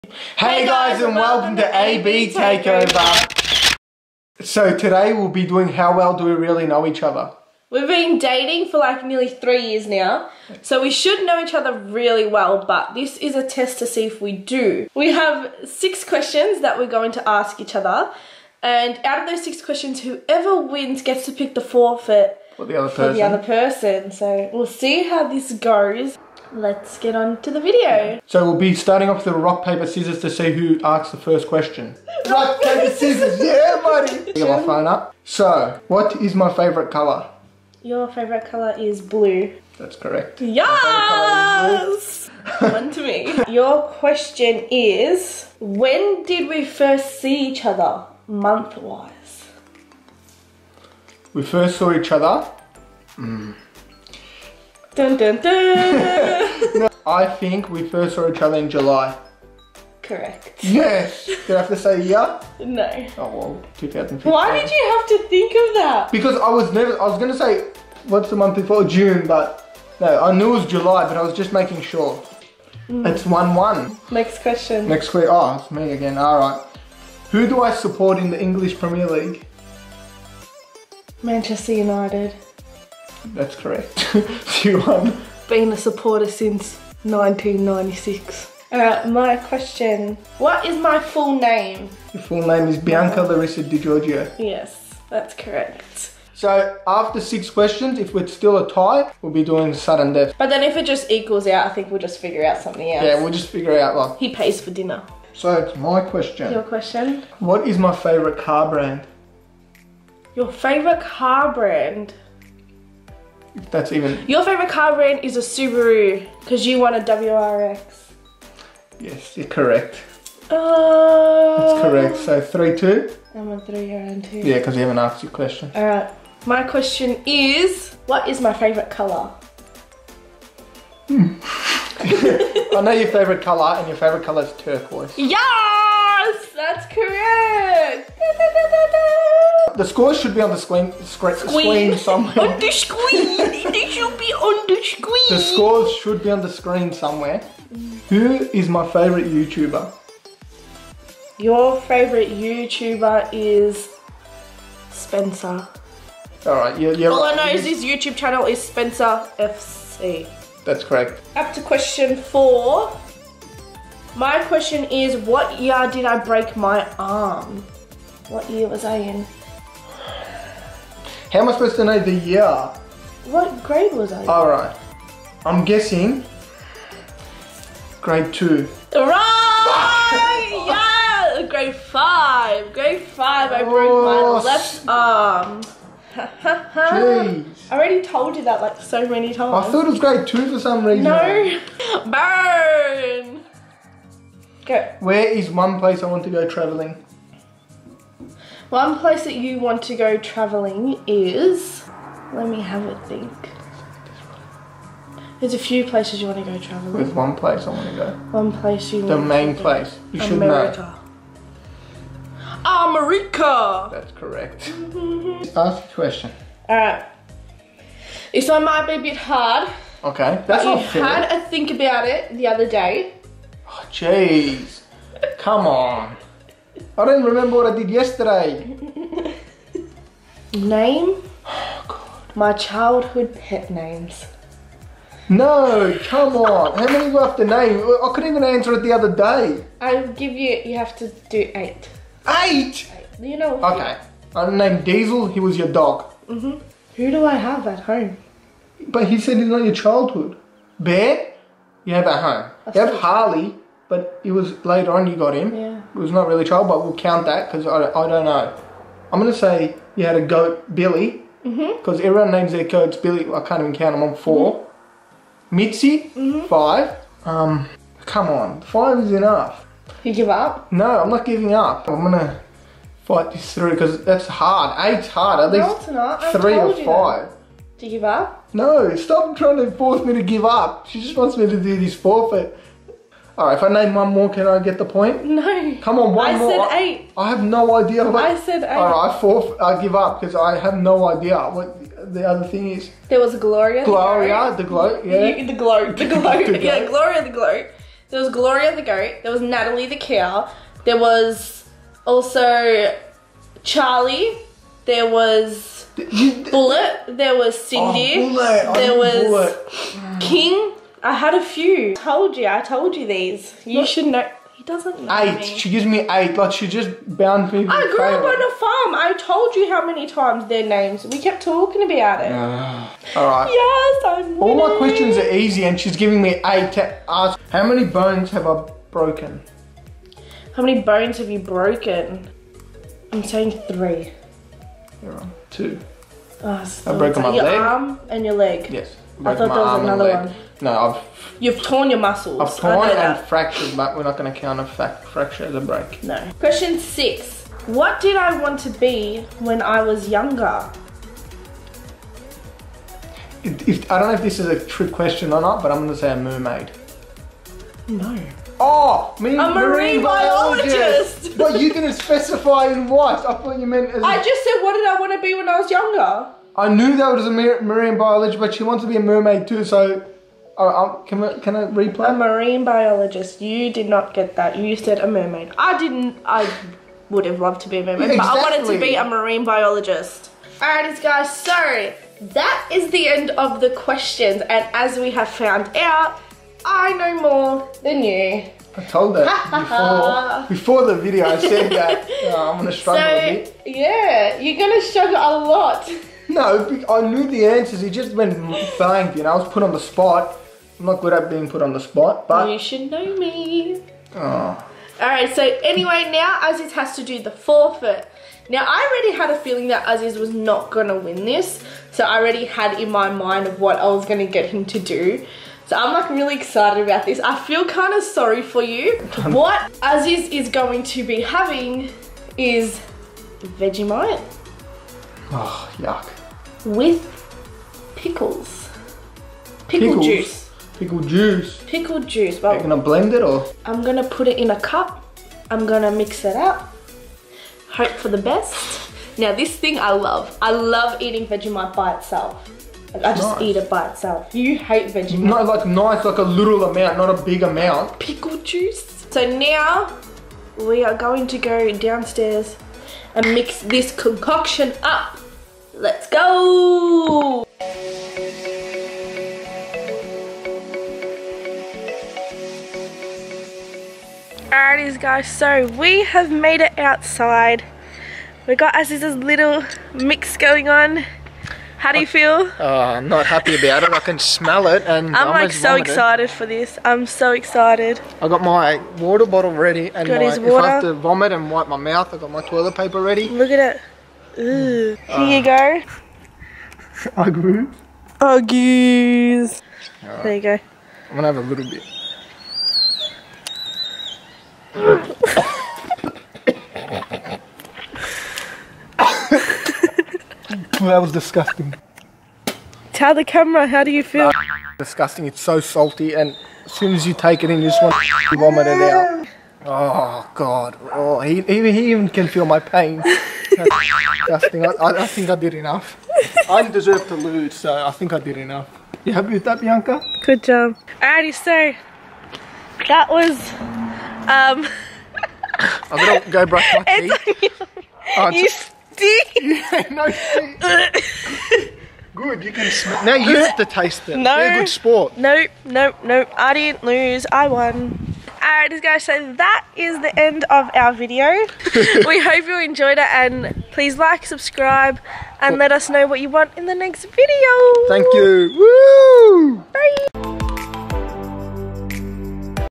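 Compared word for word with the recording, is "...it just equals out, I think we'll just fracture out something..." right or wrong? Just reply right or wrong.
wrong.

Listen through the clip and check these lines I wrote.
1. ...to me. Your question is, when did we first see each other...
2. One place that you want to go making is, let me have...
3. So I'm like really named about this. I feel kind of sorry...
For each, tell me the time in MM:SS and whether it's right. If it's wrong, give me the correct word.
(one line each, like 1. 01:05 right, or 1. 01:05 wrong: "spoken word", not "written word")
1. 00:42 right
2. 03:18 wrong: "traveling", not "making"
3. 06:55 wrong: "excited", not "named".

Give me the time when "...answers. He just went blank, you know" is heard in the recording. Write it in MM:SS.
06:37.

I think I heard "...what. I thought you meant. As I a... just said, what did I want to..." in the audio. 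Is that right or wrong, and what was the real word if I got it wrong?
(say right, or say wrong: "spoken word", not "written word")
right.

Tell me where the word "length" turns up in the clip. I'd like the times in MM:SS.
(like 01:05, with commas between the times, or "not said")
not said.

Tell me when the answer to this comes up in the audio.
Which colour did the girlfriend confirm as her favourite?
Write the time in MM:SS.
02:14.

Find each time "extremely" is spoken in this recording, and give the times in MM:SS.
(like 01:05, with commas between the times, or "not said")
not said.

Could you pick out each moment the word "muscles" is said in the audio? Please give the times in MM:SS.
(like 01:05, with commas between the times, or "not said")
05:41.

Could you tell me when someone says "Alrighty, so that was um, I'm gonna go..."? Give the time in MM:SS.
08:41.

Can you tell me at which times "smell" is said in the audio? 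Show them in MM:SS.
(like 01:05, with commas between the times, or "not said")
07:54, 08:52.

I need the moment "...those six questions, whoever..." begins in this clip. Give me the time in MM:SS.
00:19.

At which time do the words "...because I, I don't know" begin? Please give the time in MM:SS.
04:17.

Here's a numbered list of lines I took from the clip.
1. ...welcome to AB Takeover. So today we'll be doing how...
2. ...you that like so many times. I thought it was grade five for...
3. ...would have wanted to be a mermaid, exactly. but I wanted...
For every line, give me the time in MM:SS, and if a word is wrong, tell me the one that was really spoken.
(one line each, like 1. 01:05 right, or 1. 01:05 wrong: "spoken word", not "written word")
1. 00:01 right
2. 03:08 wrong: "two", not "five"
3. 06:17 wrong: "loved", not "wanted".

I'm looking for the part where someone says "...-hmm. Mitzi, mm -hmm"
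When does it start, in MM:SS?
04:24.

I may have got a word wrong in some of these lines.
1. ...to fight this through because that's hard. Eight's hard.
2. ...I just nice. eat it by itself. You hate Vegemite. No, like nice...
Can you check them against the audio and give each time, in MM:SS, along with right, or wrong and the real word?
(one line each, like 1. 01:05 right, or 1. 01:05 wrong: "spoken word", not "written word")
1. 04:32 right
2. 07:23 right.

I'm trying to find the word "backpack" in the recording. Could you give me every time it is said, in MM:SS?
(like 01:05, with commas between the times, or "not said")
not said.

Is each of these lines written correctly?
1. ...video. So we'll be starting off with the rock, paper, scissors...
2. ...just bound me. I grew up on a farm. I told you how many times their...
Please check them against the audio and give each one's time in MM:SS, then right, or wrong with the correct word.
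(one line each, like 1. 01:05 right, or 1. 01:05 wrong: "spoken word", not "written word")
1. 00:27 right
2. 05:16 right.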